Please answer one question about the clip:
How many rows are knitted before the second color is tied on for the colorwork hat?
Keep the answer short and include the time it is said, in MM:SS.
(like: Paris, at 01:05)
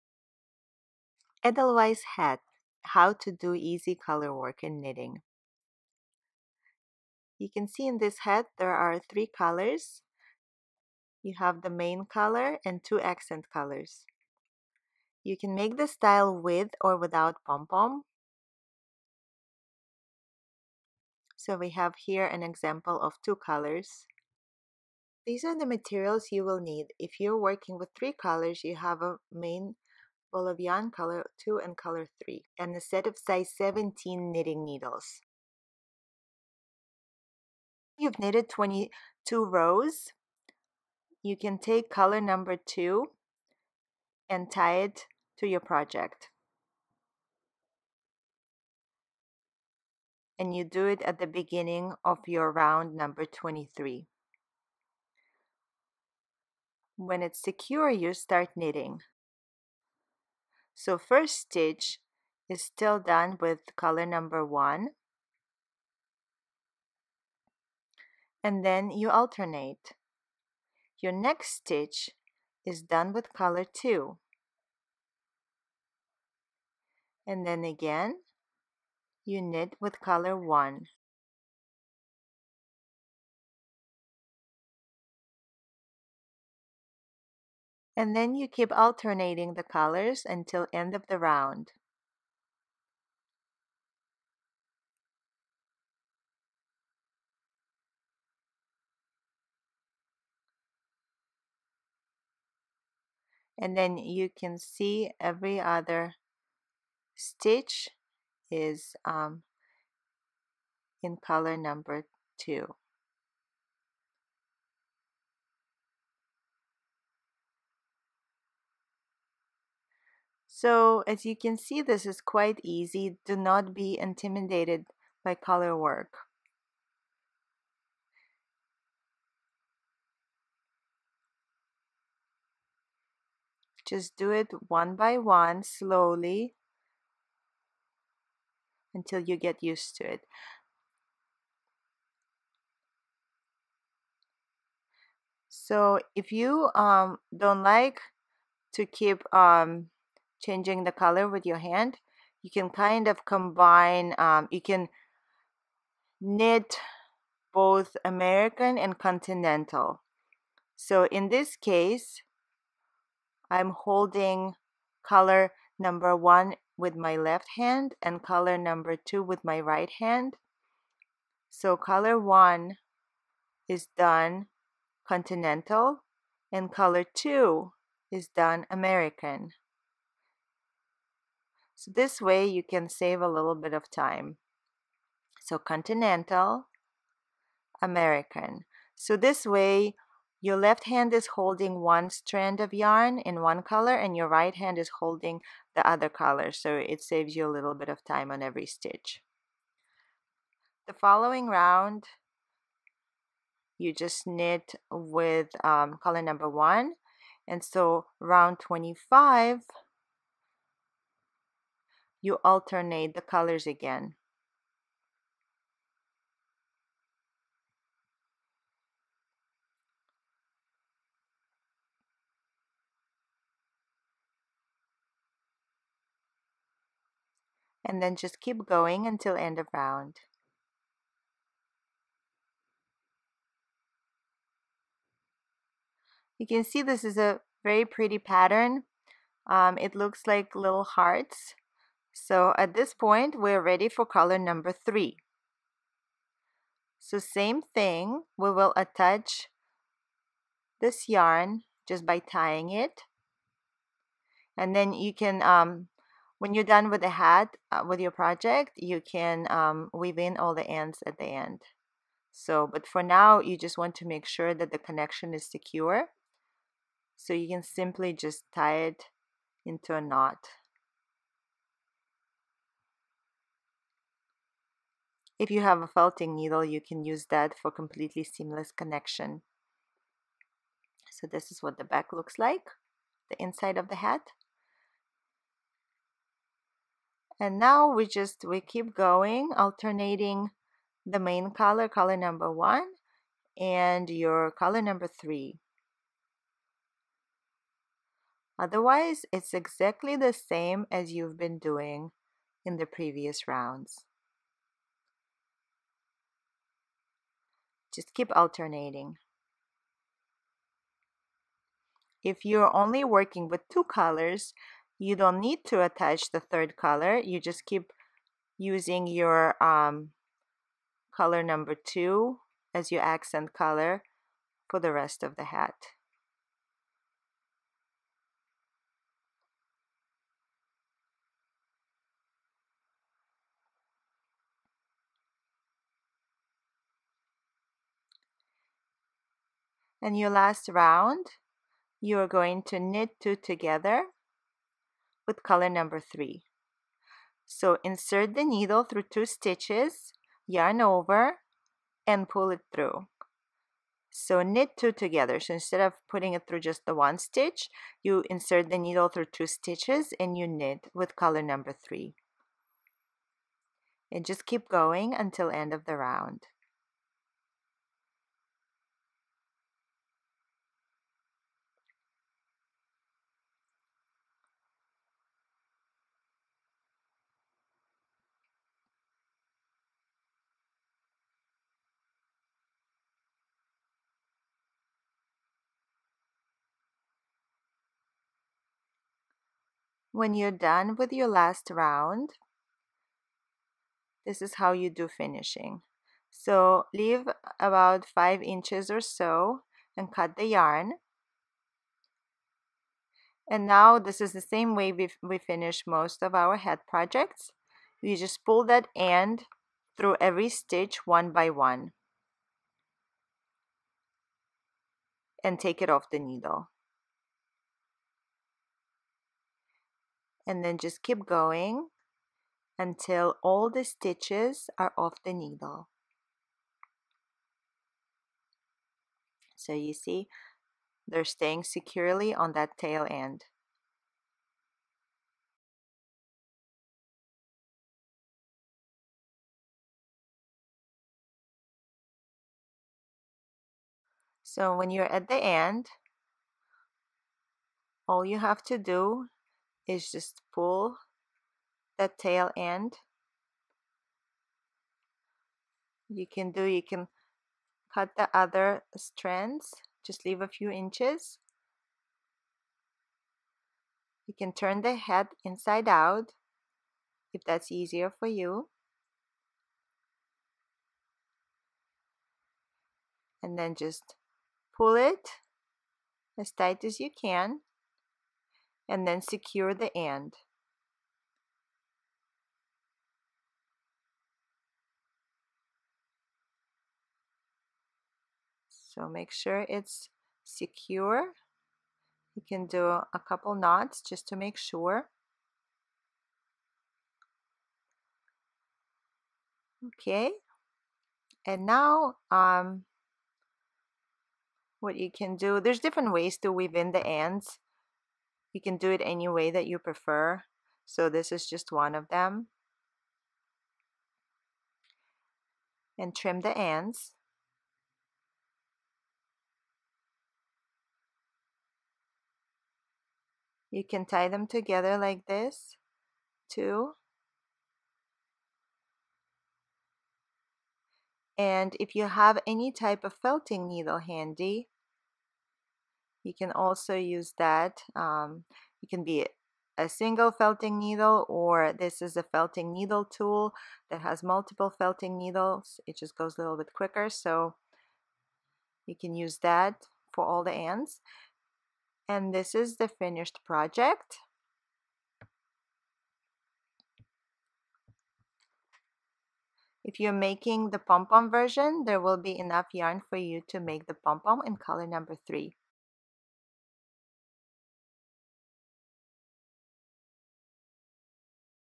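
22, at 00:38.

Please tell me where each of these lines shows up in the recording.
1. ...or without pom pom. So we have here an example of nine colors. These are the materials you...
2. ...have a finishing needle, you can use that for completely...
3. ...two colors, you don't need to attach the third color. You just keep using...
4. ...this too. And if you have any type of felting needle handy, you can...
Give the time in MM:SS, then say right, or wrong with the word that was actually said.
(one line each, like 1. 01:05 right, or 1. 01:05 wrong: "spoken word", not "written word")
1. 00:16 wrong: "two", not "nine"
2. 04:35 wrong: "felting", not "finishing"
3. 05:13 right
4. 08:45 right.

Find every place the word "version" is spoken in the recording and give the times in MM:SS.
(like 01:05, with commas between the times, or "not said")
09:21.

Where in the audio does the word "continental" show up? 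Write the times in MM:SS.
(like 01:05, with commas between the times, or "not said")
02:38, 02:55, 03:05.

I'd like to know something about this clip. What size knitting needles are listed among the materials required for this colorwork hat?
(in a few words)
17.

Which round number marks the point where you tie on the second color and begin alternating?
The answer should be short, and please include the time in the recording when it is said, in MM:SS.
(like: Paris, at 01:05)
23, at 00:52.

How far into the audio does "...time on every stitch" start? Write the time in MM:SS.
03:18.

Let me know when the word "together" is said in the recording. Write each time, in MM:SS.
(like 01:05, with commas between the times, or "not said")
05:43, 05:54, 08:44.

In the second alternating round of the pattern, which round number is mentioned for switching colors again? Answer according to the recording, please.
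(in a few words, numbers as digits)
25.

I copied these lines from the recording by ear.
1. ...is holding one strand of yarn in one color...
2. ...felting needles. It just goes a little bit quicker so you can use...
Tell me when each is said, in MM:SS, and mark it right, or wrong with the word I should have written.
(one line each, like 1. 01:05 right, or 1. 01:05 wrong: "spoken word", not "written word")
1. 03:11 right
2. 09:04 right.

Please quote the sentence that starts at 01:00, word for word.
So first stitch is still done with color number one.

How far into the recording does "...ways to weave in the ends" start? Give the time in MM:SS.
08:26.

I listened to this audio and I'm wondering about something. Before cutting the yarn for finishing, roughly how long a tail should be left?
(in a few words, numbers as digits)
5 inches.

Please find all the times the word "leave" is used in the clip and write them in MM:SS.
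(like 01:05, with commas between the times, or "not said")
06:36, 07:40.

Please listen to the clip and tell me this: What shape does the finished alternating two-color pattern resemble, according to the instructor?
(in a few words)
little hearts.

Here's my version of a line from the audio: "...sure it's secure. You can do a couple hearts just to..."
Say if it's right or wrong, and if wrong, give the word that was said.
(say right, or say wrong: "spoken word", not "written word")
wrong: "knots", not "hearts".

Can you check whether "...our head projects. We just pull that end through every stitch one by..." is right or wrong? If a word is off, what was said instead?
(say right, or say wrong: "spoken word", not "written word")
right.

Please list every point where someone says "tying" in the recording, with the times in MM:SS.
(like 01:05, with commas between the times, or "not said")
04:12.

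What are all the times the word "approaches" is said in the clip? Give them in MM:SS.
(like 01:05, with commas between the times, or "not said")
not said.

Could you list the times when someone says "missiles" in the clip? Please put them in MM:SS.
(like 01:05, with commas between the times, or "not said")
not said.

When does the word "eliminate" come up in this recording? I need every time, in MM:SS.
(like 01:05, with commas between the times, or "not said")
not said.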